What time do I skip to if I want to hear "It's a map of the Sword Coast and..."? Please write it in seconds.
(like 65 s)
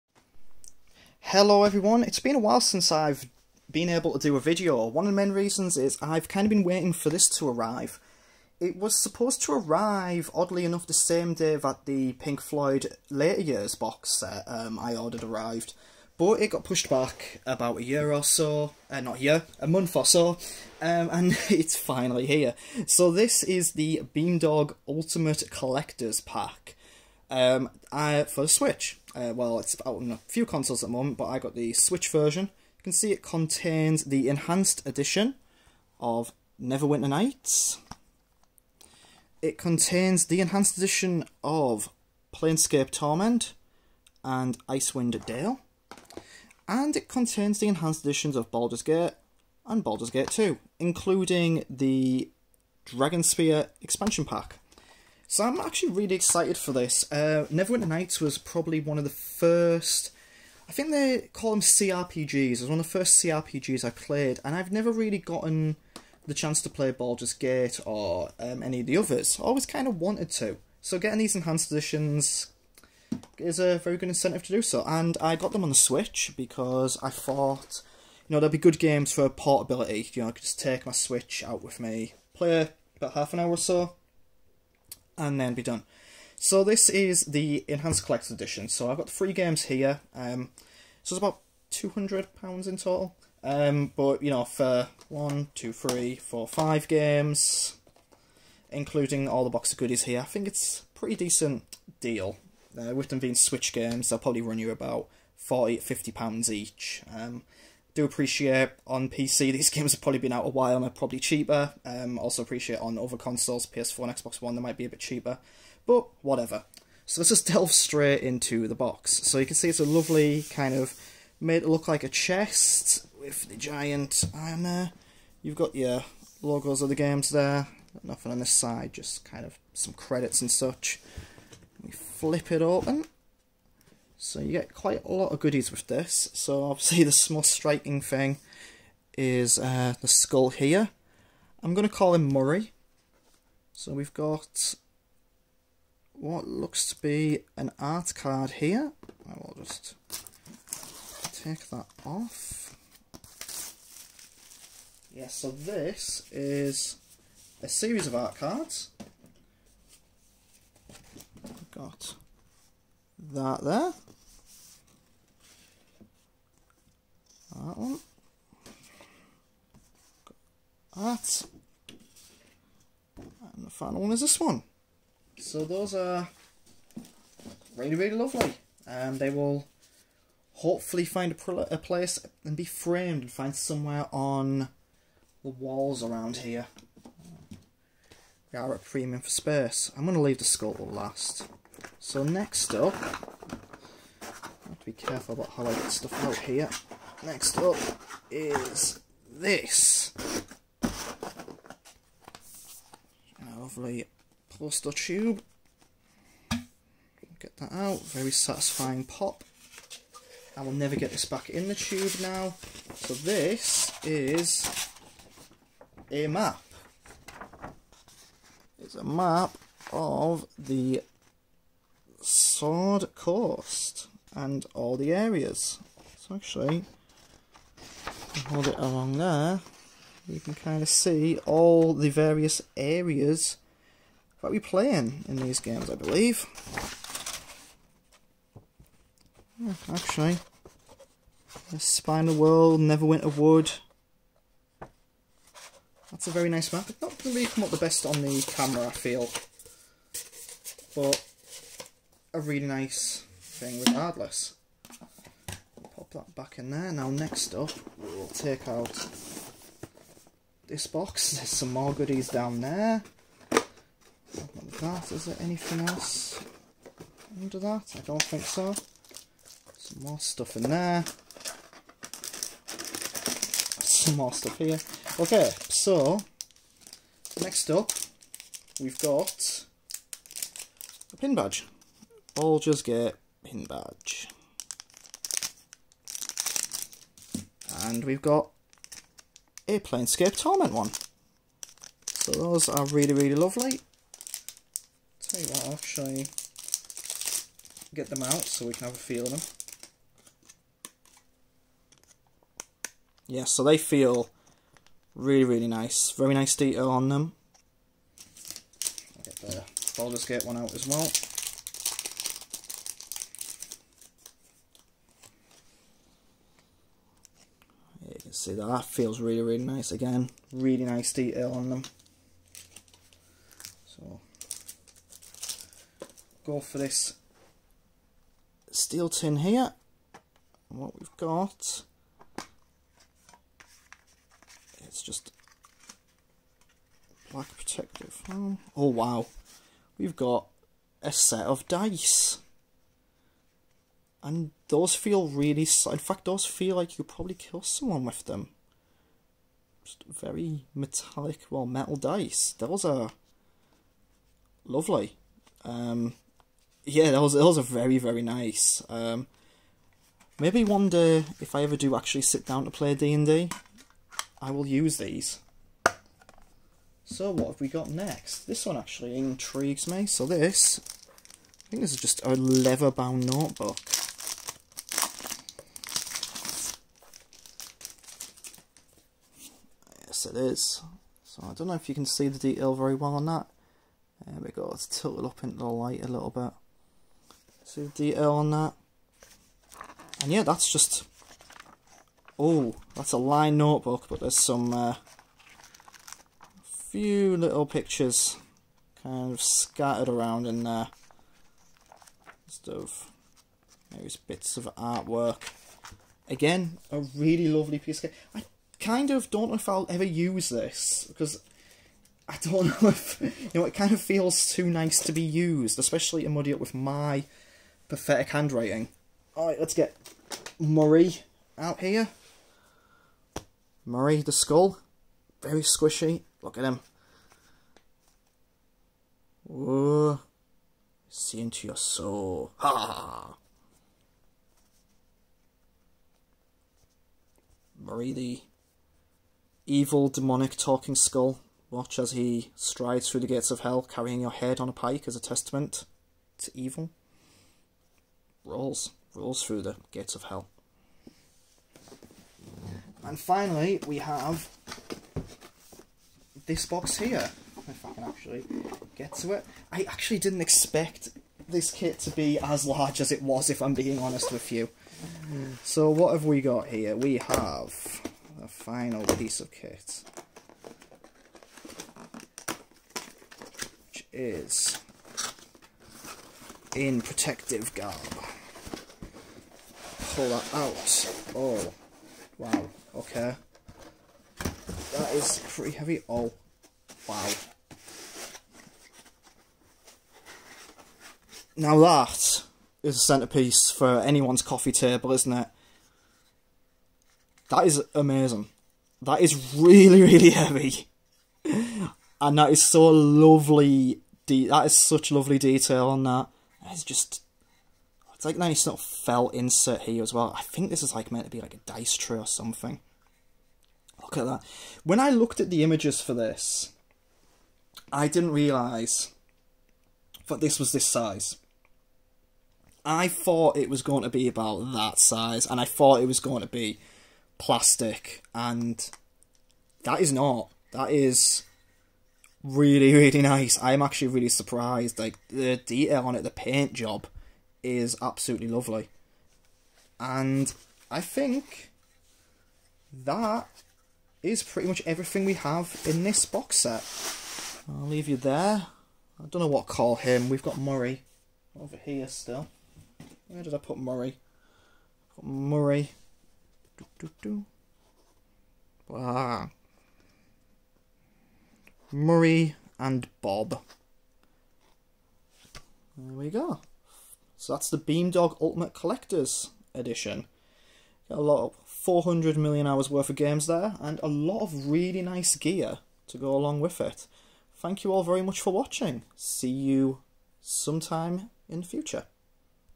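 218 s.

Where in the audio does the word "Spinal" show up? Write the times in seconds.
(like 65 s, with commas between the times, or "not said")
241 s.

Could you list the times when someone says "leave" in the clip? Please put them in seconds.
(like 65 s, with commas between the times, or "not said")
190 s, 547 s.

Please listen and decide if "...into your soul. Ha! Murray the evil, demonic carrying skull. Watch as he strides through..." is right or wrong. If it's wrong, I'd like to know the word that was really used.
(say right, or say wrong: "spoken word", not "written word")
wrong: "talking", not "carrying".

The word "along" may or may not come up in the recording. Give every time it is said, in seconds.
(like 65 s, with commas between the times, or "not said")
228 s, 576 s.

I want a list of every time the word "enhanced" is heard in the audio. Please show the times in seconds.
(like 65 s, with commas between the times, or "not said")
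34 s, 40 s, 47 s, 71 s, 87 s.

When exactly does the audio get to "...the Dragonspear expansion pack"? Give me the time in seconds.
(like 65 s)
51 s.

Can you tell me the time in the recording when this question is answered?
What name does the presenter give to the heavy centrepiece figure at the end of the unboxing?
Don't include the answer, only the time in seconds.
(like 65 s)
561 s.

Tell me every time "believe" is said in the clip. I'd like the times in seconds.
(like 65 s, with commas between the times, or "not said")
235 s.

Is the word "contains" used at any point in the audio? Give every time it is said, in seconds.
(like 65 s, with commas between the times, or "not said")
33 s, 39 s, 47 s.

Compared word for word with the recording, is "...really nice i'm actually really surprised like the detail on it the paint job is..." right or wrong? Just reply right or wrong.
right.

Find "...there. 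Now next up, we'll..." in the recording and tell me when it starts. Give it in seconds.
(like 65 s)
256 s.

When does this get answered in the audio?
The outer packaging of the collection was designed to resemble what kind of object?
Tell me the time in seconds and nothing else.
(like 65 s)
121 s.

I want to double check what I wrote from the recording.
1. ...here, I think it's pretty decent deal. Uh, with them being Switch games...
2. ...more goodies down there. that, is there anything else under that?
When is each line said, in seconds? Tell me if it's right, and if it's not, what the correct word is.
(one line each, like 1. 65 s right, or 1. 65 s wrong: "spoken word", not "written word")
1. 100 s right
2. 261 s right.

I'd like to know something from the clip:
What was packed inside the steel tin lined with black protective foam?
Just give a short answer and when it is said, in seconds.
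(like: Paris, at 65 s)
A set of dice, at 339 s.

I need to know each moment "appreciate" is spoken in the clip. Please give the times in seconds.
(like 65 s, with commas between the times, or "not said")
108 s, 112 s.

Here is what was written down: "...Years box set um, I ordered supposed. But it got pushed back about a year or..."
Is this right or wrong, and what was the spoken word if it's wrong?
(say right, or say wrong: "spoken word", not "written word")
wrong: "arrived", not "supposed".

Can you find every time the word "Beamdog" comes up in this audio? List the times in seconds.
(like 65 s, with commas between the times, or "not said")
24 s, 567 s.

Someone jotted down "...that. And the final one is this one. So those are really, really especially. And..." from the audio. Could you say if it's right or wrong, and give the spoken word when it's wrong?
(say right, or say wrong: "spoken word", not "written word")
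wrong: "lovely", not "especially".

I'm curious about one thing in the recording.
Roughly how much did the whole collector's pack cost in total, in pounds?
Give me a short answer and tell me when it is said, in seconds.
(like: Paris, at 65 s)
£200, at 91 s.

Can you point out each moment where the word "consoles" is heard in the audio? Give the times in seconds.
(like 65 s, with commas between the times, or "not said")
30 s, 113 s.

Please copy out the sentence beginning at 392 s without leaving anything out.
Oh, that's a line notebook, but there's some uh, few little pictures kind of scattered around in there.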